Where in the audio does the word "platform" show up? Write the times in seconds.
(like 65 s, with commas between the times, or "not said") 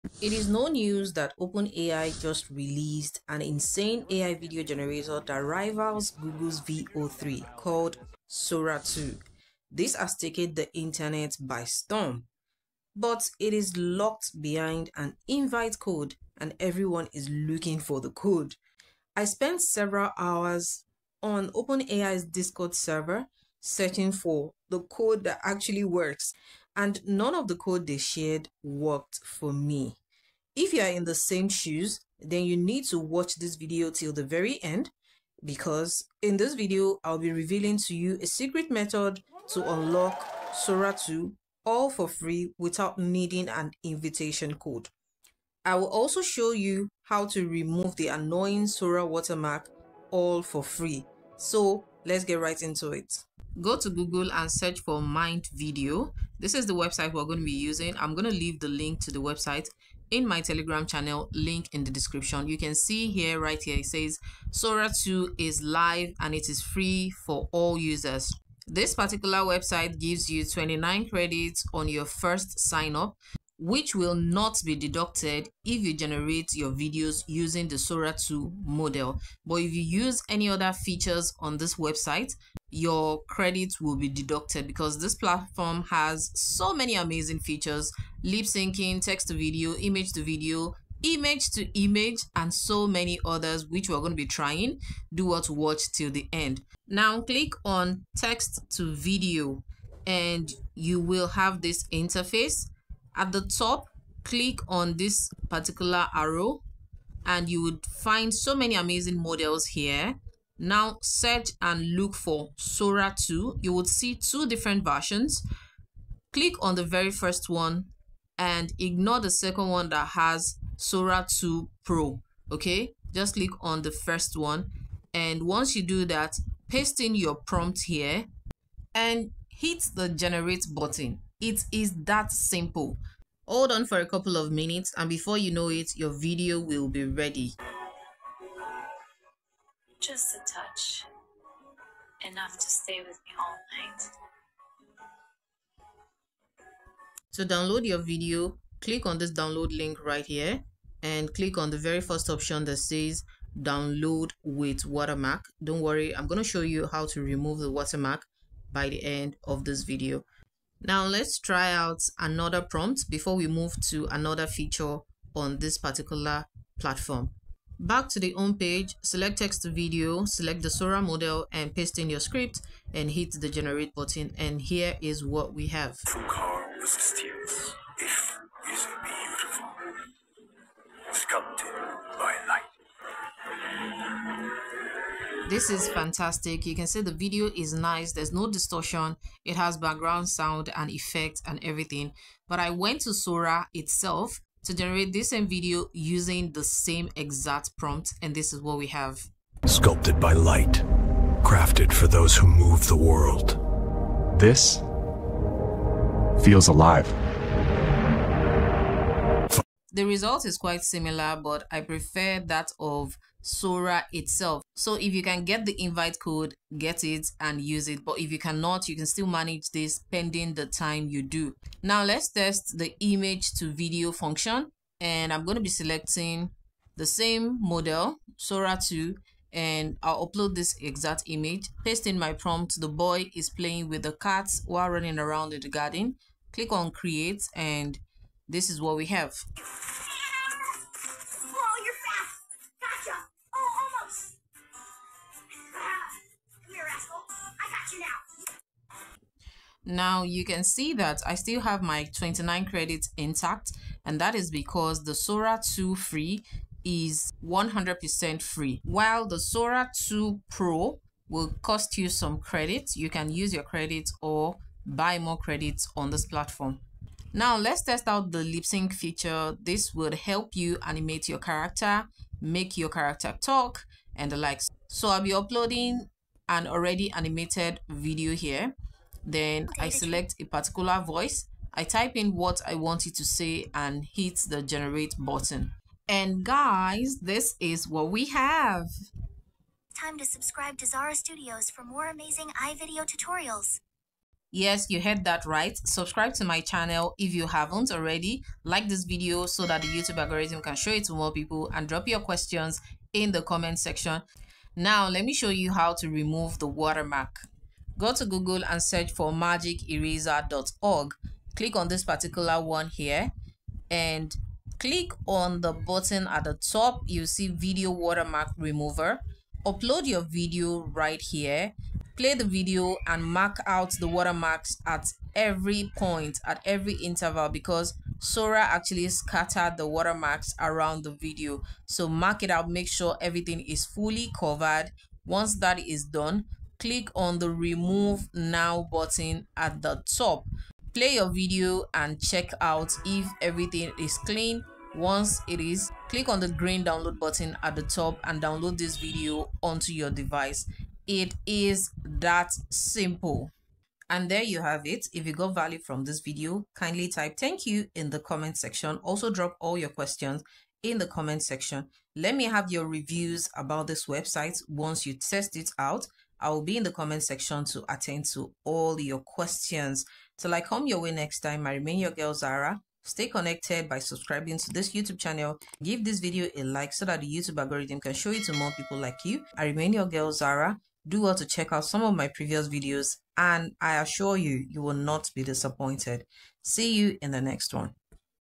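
85 s, 166 s, 266 s.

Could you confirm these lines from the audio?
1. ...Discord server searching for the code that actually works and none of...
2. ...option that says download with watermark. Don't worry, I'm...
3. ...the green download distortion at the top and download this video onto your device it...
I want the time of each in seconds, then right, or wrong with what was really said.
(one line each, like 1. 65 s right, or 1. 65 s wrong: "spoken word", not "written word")
1. 22 s right
2. 152 s right
3. 346 s wrong: "button", not "distortion".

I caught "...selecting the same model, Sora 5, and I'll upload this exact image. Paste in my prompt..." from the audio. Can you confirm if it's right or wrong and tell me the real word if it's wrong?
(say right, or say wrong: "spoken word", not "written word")
wrong: "2", not "5".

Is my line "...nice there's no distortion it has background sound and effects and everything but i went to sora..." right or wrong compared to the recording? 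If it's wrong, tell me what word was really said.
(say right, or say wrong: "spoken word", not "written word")
right.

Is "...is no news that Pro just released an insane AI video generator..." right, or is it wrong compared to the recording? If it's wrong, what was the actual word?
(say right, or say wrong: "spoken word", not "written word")
wrong: "OpenAI", not "Pro".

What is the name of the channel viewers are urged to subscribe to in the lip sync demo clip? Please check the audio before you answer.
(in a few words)
Zara Studioz.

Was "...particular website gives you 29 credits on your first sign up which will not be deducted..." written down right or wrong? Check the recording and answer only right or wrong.
right.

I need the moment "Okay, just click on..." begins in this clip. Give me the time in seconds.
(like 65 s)
122 s.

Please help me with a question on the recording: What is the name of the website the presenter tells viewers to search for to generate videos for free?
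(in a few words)
Mind Video.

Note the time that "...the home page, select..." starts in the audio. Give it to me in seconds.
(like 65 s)
168 s.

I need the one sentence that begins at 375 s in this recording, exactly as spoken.
Give this video a like so that the YouTube algorithm can show it to more people like you.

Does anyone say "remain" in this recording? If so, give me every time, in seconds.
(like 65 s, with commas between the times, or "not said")
371 s, 379 s.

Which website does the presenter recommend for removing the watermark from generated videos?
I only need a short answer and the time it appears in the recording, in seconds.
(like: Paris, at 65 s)
magiceraser.org, at 309 s.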